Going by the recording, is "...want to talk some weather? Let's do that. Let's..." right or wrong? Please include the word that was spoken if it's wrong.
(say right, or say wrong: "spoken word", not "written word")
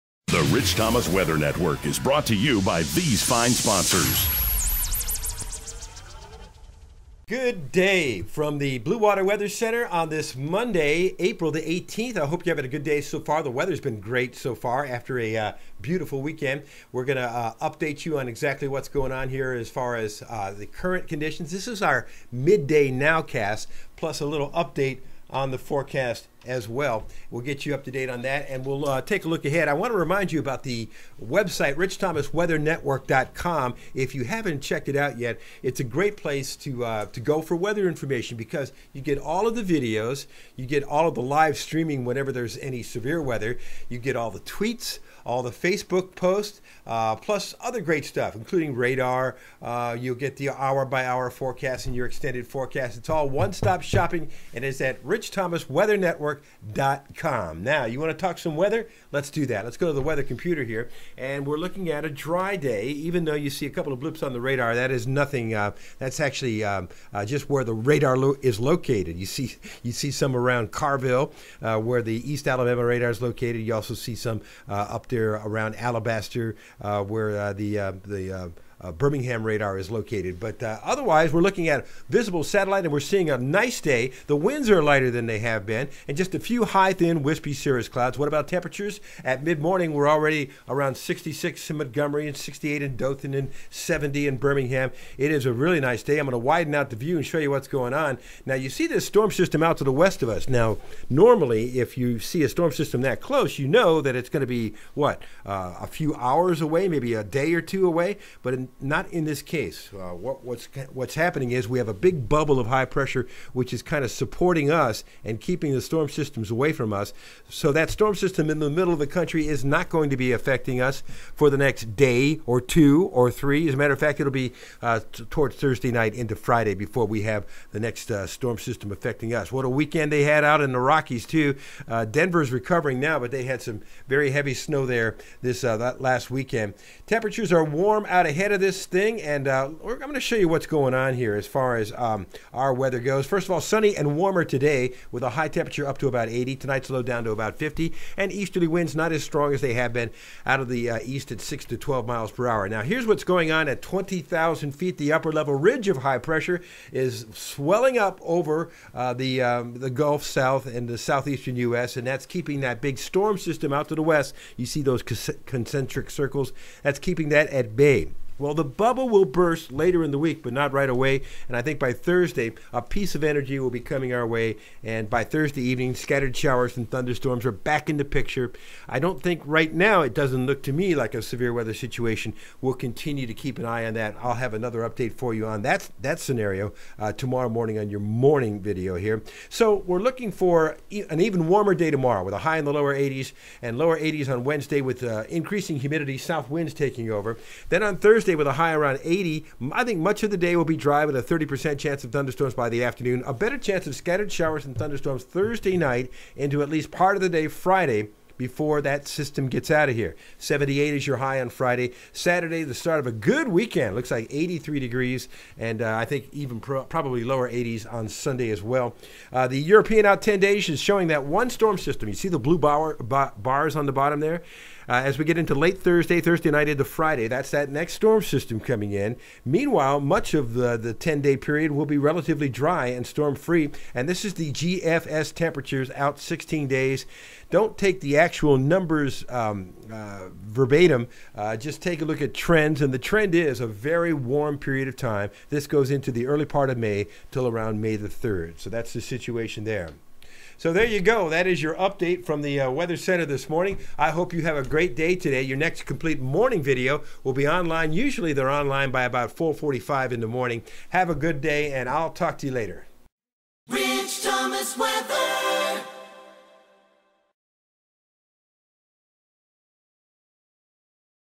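right.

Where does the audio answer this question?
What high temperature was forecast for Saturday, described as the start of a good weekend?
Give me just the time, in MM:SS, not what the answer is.
03:34.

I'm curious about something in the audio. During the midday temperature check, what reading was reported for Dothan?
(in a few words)
68.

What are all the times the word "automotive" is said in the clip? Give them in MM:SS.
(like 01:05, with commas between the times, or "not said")
not said.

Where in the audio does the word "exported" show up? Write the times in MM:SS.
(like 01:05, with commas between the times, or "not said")
not said.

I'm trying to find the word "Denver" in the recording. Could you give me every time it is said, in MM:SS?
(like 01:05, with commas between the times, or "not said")
02:12.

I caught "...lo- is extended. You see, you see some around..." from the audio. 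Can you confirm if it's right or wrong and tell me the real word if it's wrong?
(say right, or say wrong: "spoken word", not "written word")
wrong: "located", not "extended".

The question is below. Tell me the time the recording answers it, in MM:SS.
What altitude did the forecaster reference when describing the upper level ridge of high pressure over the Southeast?
02:33.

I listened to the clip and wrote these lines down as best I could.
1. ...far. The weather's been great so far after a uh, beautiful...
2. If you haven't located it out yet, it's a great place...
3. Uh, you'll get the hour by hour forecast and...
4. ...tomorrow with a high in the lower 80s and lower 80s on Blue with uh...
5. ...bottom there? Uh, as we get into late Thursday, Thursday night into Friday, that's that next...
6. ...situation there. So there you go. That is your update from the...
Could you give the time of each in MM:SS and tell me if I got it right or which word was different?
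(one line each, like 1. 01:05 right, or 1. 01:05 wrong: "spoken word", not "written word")
1. 00:13 right
2. 00:33 wrong: "checked", not "located"
3. 00:49 right
4. 03:11 wrong: "Wednesday", not "Blue"
5. 03:43 right
6. 04:08 right.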